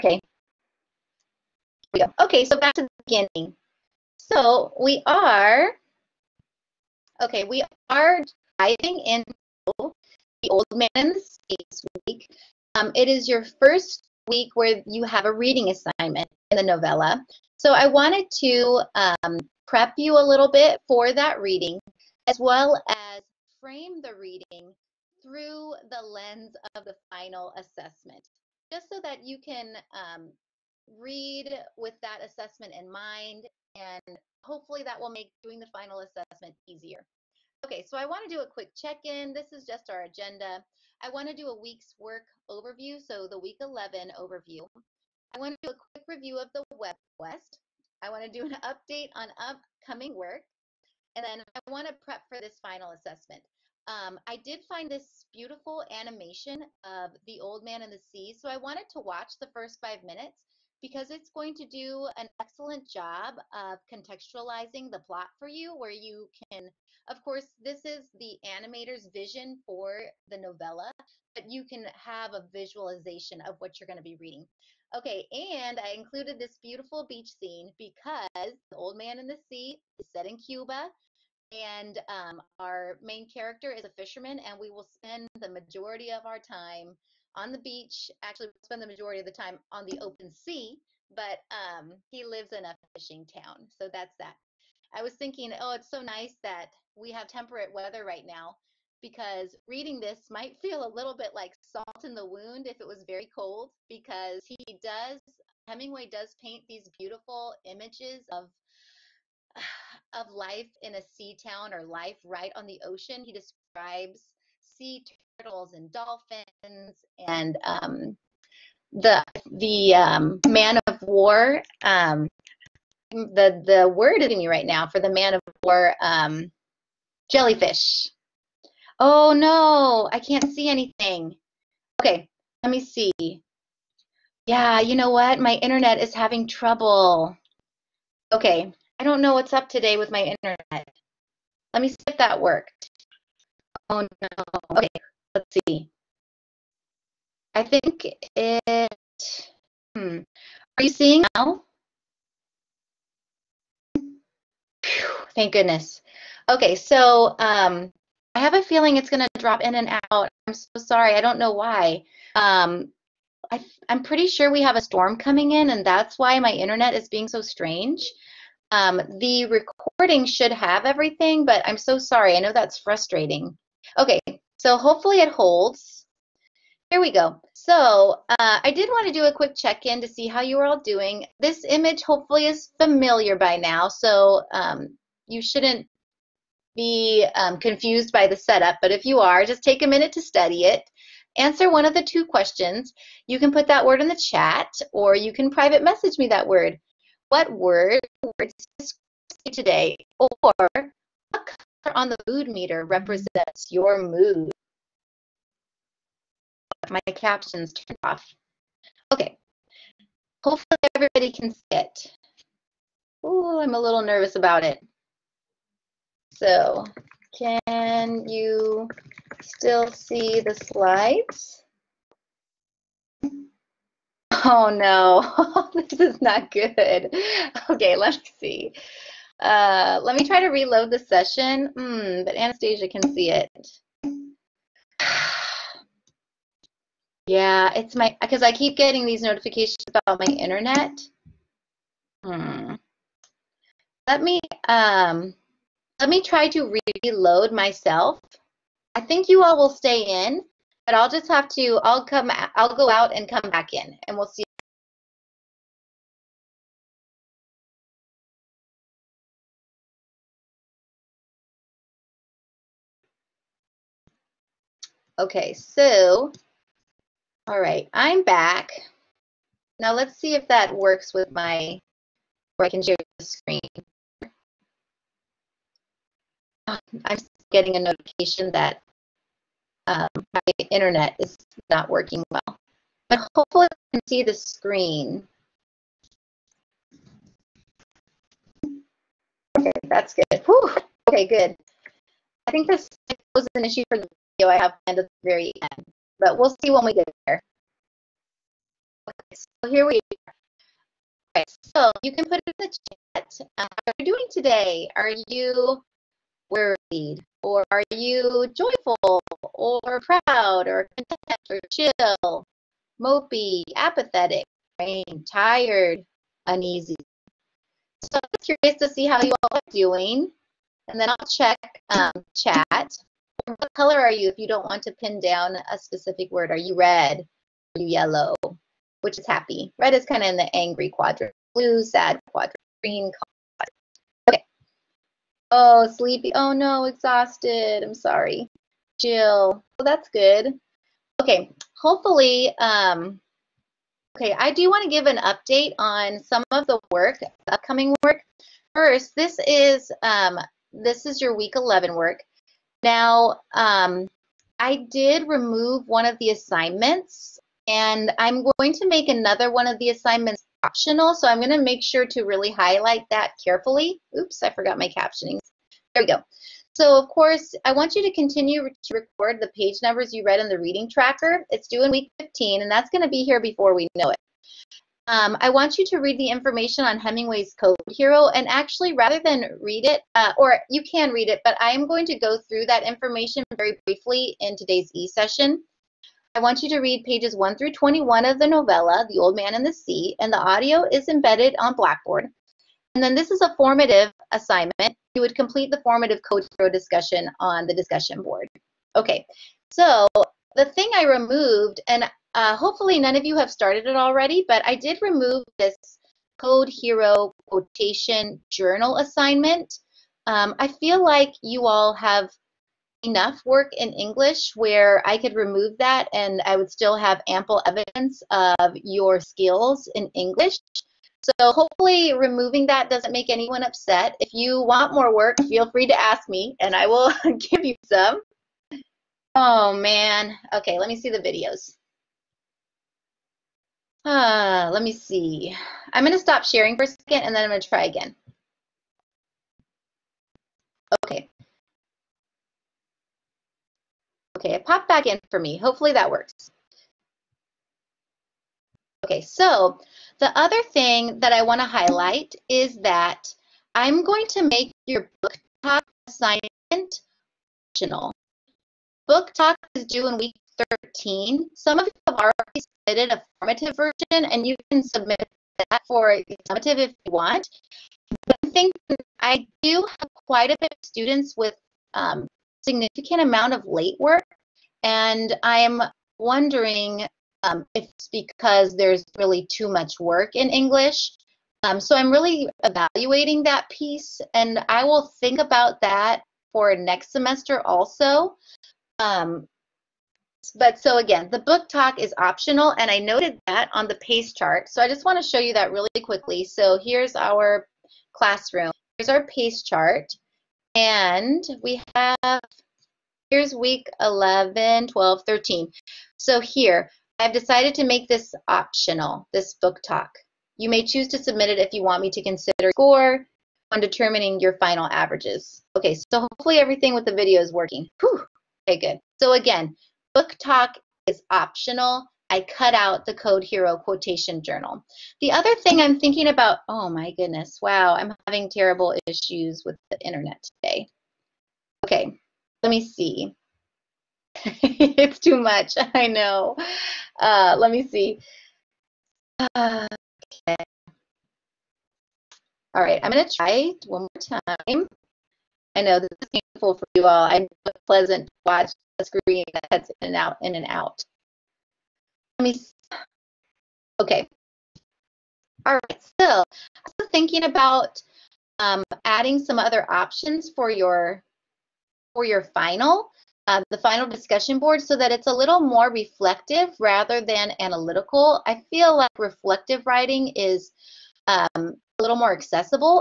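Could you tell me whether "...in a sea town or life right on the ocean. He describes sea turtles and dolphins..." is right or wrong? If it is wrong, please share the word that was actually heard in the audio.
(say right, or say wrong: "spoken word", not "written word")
right.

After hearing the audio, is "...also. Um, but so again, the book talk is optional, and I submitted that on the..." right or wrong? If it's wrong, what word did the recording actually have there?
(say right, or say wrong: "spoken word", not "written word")
wrong: "noted", not "submitted".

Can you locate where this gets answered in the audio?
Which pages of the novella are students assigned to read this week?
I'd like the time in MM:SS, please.
06:27.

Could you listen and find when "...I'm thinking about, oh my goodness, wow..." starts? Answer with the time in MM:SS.
08:45.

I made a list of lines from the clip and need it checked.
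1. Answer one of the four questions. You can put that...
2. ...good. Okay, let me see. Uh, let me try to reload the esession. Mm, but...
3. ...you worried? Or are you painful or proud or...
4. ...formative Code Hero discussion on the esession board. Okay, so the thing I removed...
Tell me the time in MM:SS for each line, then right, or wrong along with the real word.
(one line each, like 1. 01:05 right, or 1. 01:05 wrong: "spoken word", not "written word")
1. 03:11 wrong: "two", not "four"
2. 03:46 wrong: "session", not "esession"
3. 05:05 wrong: "joyful", not "painful"
4. 06:35 wrong: "discussion", not "esession".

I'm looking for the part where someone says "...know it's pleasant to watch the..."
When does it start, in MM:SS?
09:07.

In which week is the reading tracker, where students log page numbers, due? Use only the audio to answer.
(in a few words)
week 15.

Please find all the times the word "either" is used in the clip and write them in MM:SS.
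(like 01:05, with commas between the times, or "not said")
not said.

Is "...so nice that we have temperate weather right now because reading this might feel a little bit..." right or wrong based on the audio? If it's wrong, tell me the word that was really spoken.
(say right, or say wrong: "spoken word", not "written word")
right.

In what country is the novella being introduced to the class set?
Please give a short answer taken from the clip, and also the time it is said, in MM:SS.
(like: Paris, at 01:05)
Cuba, at 01:20.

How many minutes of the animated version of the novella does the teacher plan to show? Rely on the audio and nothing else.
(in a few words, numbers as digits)
5.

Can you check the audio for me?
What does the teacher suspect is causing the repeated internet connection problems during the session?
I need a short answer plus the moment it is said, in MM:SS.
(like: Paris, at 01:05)
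a storm, at 02:44.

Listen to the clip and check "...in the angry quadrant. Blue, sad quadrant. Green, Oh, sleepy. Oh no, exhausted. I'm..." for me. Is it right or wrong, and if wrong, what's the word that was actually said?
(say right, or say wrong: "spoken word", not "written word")
right.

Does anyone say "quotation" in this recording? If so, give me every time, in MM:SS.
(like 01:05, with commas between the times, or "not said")
06:47, 08:43.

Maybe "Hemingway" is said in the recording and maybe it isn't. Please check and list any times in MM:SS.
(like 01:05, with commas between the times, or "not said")
01:45, 06:16.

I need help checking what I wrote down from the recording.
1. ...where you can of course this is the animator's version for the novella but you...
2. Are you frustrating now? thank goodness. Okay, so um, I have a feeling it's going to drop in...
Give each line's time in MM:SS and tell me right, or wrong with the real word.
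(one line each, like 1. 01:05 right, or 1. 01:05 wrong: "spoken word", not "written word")
1. 01:05 wrong: "vision", not "version"
2. 02:30 wrong: "seeing", not "frustrating".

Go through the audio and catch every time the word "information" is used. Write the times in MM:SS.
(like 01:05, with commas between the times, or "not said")
06:16, 06:22.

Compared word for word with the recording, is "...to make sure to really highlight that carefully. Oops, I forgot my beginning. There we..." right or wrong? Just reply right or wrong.
wrong.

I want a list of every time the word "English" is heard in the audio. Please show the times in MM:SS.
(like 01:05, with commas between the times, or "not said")
06:53, 07:00, 08:00.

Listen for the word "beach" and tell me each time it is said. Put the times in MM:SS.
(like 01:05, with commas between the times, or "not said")
01:17, 01:27.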